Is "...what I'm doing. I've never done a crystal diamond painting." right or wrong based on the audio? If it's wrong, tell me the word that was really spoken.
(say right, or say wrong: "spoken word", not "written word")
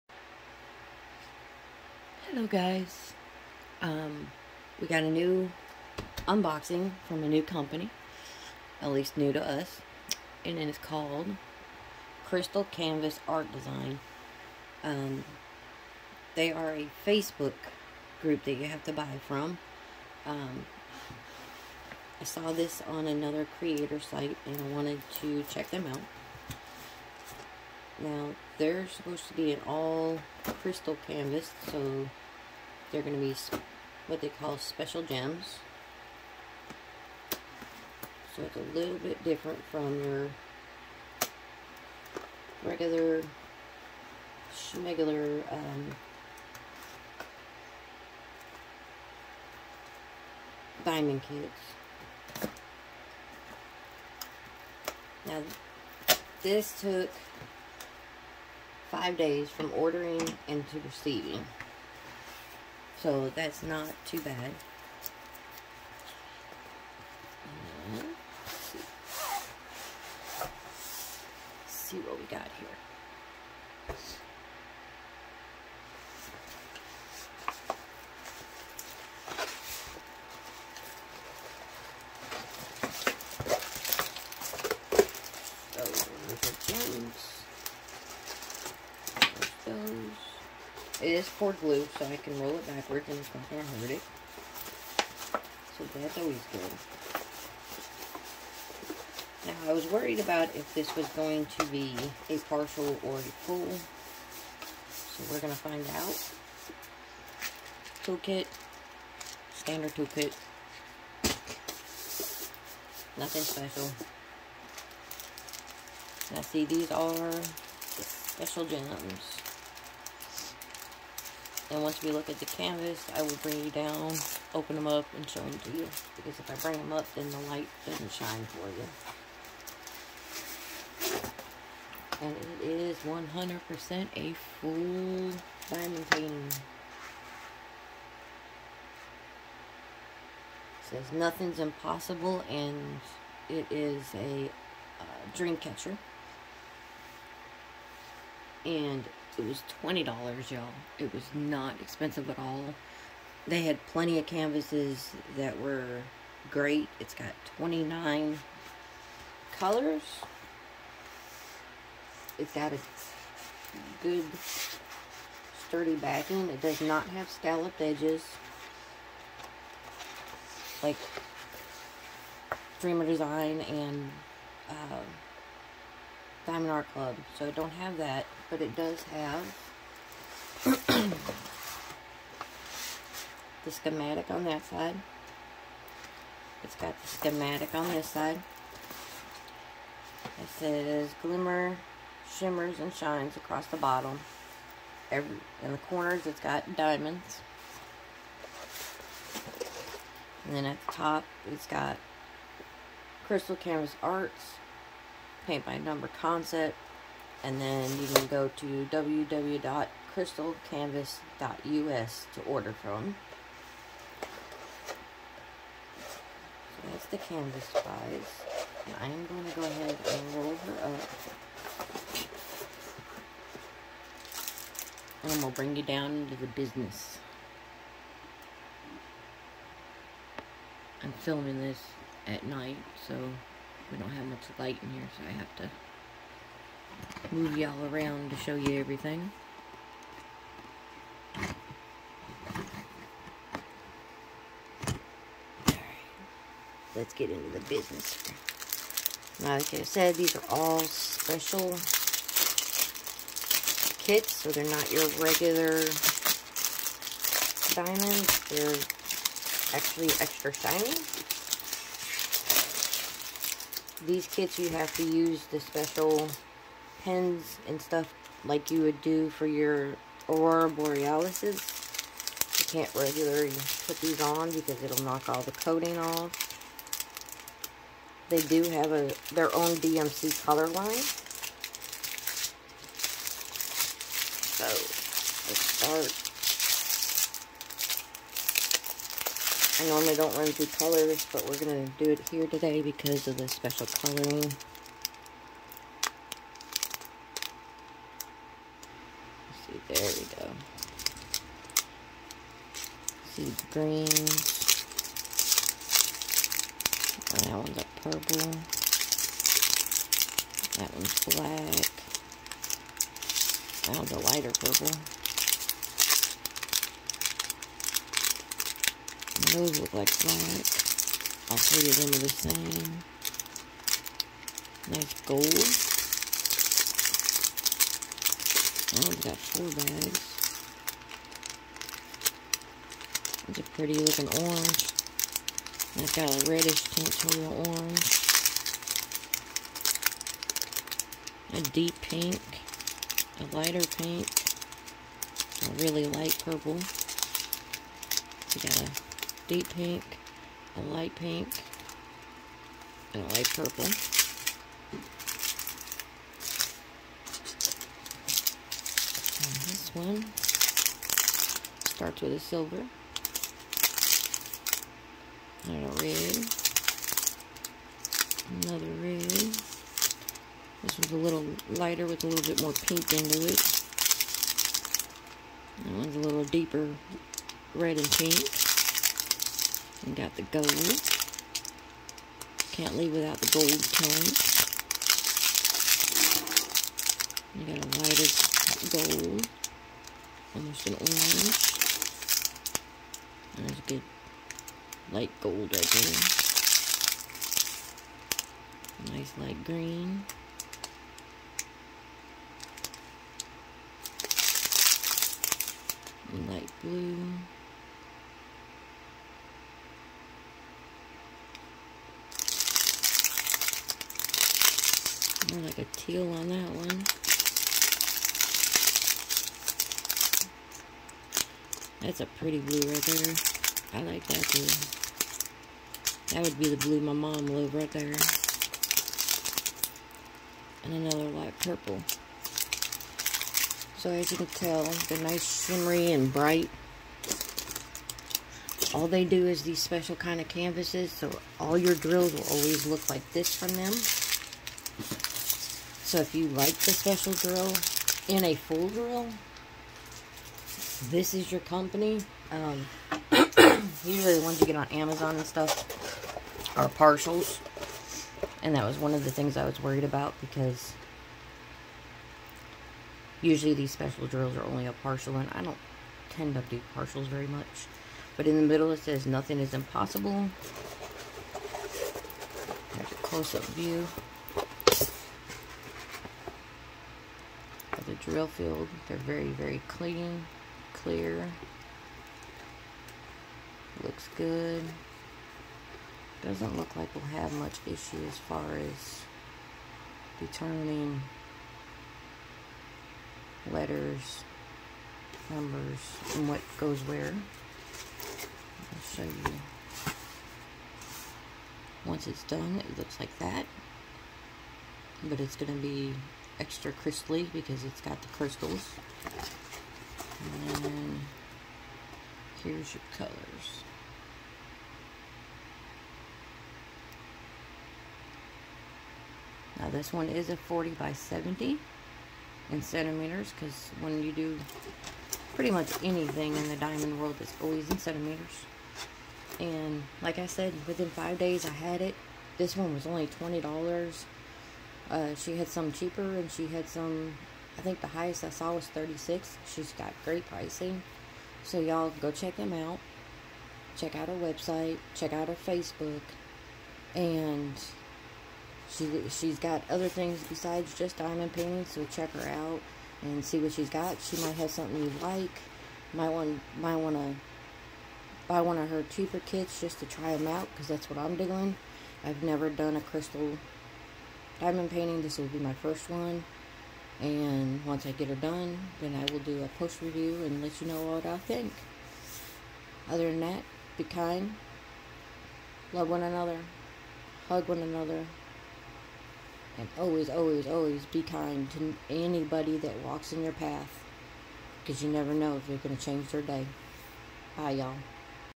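right.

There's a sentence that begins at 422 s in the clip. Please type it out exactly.
That's a pretty blue right there.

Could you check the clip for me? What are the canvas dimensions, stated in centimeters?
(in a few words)
40 by 70.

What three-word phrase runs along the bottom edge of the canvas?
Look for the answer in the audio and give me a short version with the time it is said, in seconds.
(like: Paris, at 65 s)
Glimmer, shimmers, and shines, at 191 s.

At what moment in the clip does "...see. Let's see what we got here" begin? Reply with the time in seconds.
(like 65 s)
68 s.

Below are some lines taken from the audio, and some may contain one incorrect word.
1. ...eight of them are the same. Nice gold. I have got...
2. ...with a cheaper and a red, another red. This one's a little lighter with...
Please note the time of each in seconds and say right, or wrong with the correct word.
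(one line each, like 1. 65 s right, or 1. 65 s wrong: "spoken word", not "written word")
1. 321 s wrong: "three", not "eight"
2. 362 s wrong: "silver", not "cheaper".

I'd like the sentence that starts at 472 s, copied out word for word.
There's a close-up view of the drill field.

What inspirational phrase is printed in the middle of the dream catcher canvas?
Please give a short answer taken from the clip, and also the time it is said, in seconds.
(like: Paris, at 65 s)
Nothing's impossible, at 141 s.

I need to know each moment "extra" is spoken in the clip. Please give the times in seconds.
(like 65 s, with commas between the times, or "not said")
260 s, 506 s.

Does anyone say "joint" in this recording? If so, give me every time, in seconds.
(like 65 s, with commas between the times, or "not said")
not said.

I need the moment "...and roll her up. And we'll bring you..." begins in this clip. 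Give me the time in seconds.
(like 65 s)
220 s.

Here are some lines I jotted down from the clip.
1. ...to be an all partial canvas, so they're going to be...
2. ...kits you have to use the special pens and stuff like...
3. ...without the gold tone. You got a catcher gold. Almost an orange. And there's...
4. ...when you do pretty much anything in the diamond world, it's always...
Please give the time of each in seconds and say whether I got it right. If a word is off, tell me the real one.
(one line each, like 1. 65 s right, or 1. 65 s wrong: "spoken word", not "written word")
1. 29 s wrong: "crystal", not "partial"
2. 264 s right
3. 383 s wrong: "lighter", not "catcher"
4. 524 s right.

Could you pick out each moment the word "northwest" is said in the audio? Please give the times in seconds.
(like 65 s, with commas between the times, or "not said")
not said.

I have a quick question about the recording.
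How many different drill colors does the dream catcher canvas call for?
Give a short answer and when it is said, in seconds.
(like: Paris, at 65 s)
29, at 157 s.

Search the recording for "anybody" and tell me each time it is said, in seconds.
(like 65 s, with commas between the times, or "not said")
582 s.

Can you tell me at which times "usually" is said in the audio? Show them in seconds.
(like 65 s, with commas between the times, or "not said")
454 s, 463 s.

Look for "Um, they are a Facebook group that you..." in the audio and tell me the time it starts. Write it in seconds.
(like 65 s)
14 s.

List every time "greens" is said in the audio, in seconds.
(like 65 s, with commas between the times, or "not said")
303 s, 399 s.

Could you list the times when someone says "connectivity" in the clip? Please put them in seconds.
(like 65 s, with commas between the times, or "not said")
not said.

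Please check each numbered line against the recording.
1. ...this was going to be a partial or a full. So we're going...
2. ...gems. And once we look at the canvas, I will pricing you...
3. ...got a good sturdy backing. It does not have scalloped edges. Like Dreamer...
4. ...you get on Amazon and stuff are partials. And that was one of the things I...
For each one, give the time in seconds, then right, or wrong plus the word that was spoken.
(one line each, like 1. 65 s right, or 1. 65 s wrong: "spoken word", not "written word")
1. 100 s right
2. 118 s wrong: "bring", not "pricing"
3. 162 s right
4. 454 s right.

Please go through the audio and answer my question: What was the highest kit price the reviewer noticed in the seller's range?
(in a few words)
36.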